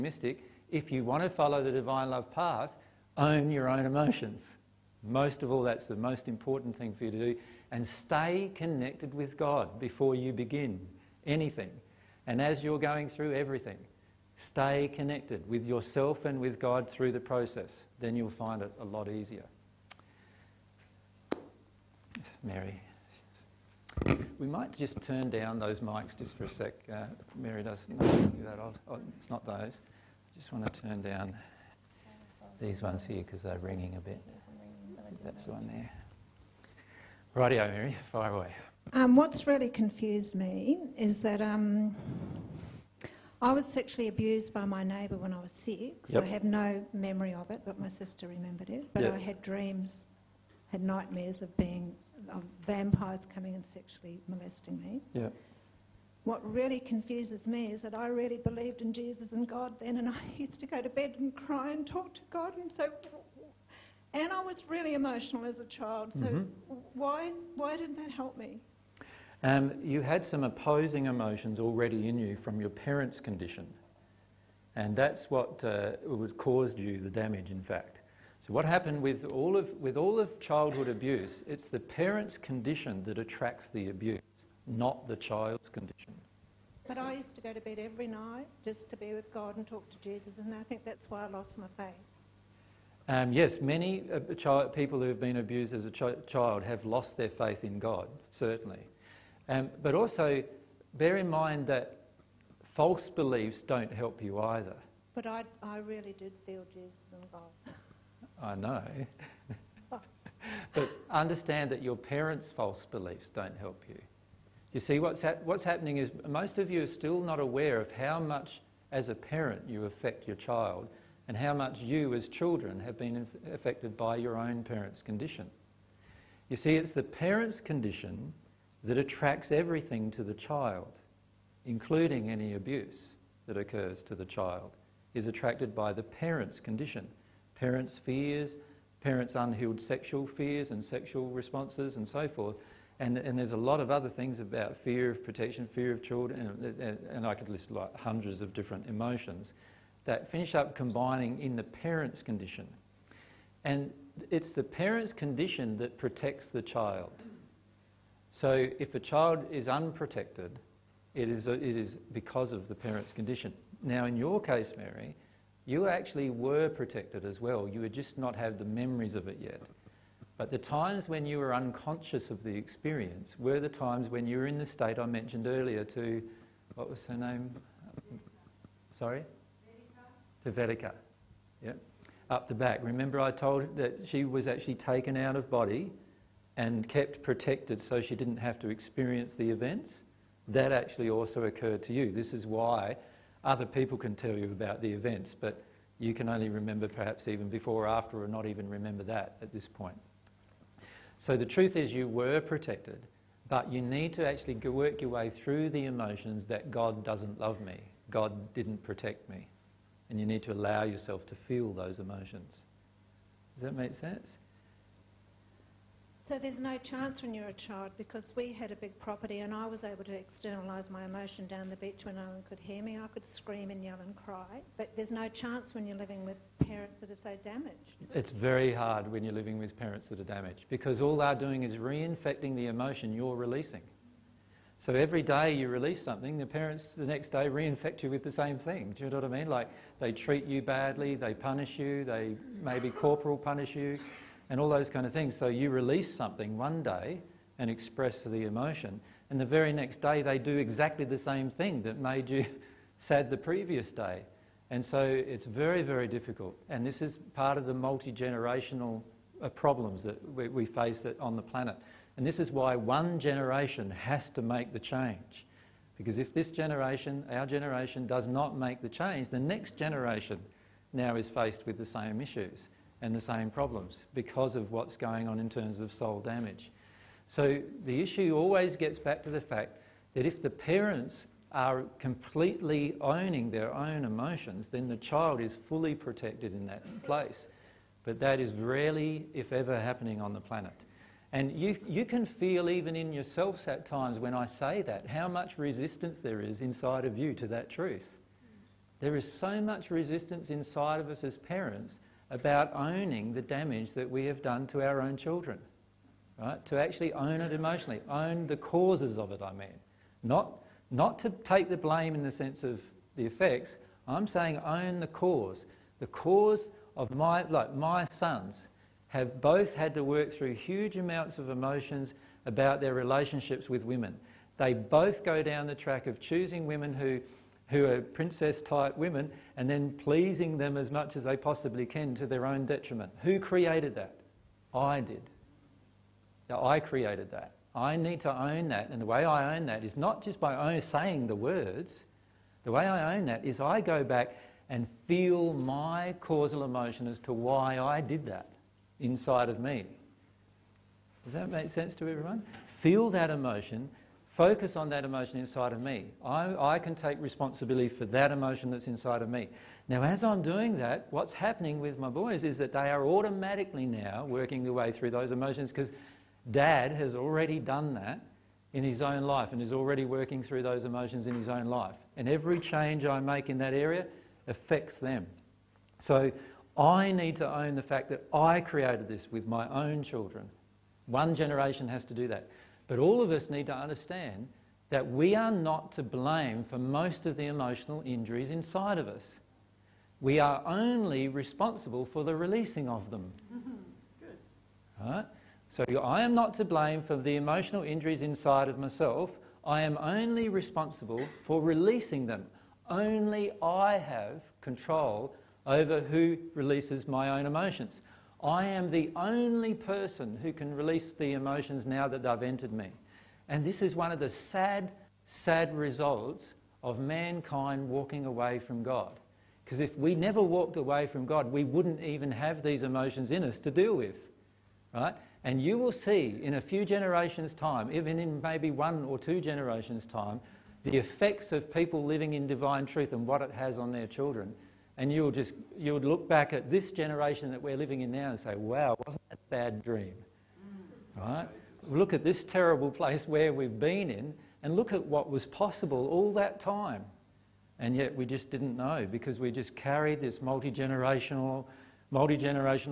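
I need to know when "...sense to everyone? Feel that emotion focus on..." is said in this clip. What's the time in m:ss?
5:51.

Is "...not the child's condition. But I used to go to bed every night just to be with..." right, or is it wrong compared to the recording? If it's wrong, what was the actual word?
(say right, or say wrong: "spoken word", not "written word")
right.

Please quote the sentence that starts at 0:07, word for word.
And stay connected with God before you begin anything.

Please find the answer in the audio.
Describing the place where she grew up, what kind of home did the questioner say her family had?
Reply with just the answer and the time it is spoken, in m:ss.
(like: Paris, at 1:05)
A big property, at 3:38.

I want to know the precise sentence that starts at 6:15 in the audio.
So I need to own the fact that I created this with my own children.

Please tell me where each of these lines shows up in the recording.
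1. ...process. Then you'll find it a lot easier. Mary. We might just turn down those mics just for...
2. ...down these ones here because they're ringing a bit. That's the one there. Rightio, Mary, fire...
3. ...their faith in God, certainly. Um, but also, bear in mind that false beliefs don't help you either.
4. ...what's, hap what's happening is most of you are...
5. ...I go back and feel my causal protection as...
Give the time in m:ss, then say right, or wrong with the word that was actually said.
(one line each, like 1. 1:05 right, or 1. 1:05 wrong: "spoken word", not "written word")
1. 0:17 right
2. 0:31 right
3. 1:37 right
4. 1:54 right
5. 5:43 wrong: "emotion", not "protection".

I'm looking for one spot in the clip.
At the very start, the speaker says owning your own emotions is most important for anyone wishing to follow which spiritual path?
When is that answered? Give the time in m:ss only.
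0:01.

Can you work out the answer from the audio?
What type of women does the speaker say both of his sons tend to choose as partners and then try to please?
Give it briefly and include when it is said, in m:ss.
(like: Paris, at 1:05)
Princess type women, at 5:28.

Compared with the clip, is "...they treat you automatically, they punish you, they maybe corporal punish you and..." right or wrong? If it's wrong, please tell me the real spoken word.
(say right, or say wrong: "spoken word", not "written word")
wrong: "badly", not "automatically".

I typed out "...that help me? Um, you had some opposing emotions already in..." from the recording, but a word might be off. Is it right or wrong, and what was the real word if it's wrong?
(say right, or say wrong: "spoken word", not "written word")
right.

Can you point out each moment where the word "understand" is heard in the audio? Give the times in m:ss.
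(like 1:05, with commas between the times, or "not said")
1:51, 6:23.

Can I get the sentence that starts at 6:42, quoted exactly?
Only I have control over who releases my own emotions.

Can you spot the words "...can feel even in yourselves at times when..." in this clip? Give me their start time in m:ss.
4:52.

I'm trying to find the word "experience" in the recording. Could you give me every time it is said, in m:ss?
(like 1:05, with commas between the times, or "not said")
2:52, 3:08.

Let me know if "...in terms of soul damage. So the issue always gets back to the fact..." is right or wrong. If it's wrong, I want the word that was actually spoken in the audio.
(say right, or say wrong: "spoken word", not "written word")
right.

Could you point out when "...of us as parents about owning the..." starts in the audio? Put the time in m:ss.
5:00.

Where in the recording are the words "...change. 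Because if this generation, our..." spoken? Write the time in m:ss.
4:24.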